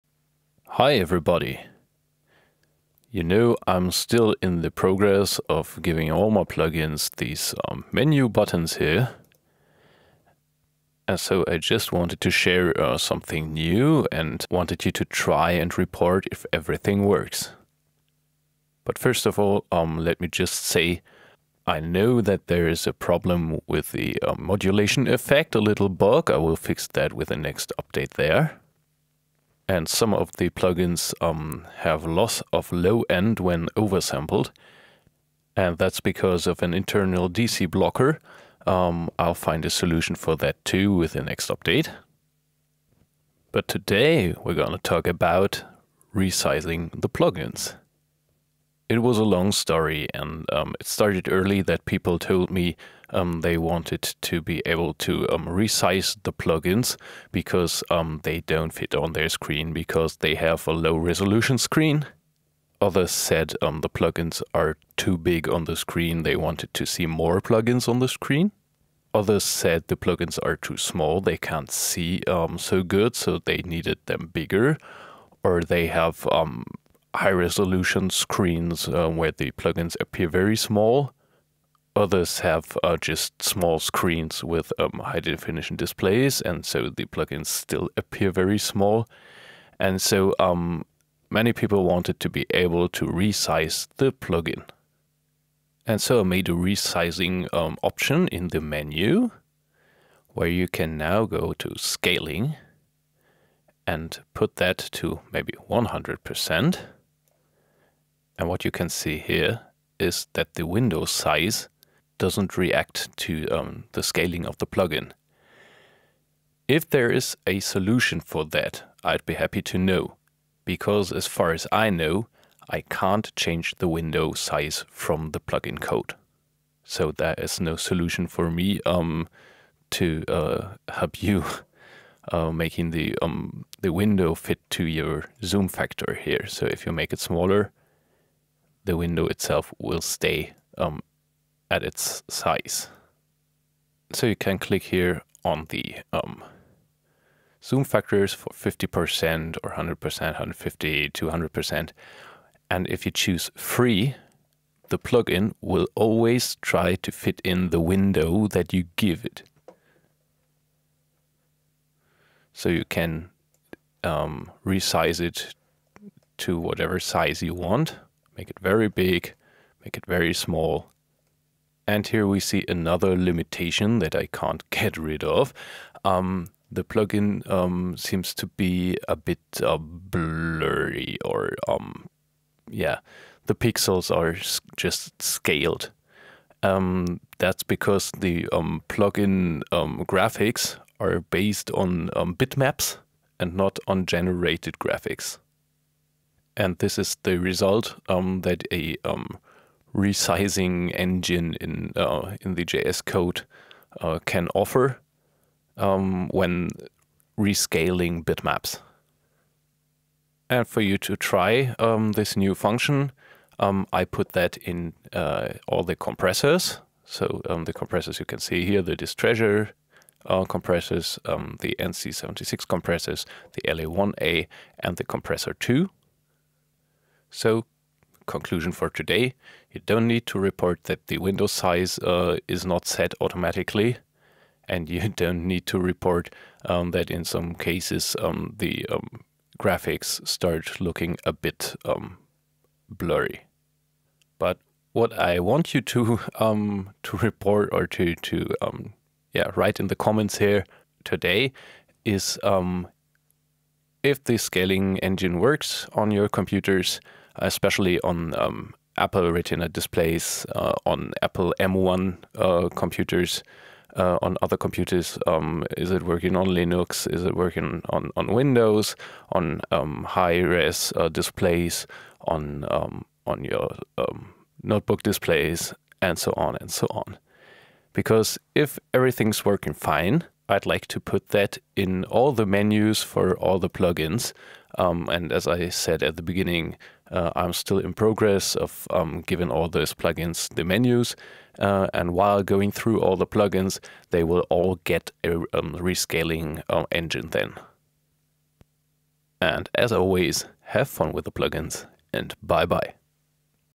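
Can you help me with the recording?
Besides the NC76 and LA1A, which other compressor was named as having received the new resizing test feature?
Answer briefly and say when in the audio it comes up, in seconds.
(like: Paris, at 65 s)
Compressor 2, at 225 s.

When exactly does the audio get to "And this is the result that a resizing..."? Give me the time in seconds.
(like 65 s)
196 s.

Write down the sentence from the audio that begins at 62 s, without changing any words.
Others said um, the plugins are too big on the screen, they wanted to see more plugins on the screen.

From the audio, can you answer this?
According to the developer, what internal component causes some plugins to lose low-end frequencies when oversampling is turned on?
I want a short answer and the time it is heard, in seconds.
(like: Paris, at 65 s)
DC blocker, at 37 s.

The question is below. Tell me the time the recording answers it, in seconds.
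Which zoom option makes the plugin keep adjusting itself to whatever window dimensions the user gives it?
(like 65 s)
153 s.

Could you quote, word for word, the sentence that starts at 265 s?
Um, is it working on Linux?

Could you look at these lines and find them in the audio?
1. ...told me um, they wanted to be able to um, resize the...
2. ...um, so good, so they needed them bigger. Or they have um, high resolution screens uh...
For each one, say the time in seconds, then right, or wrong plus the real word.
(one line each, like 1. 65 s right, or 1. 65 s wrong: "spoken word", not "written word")
1. 52 s right
2. 72 s right.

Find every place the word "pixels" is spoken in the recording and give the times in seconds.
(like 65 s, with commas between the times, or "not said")
183 s.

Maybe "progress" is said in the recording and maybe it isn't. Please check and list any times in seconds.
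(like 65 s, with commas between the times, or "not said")
4 s, 287 s.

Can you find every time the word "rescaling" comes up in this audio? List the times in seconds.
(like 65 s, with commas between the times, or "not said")
207 s, 295 s.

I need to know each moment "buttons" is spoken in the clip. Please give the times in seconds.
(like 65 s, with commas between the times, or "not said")
8 s.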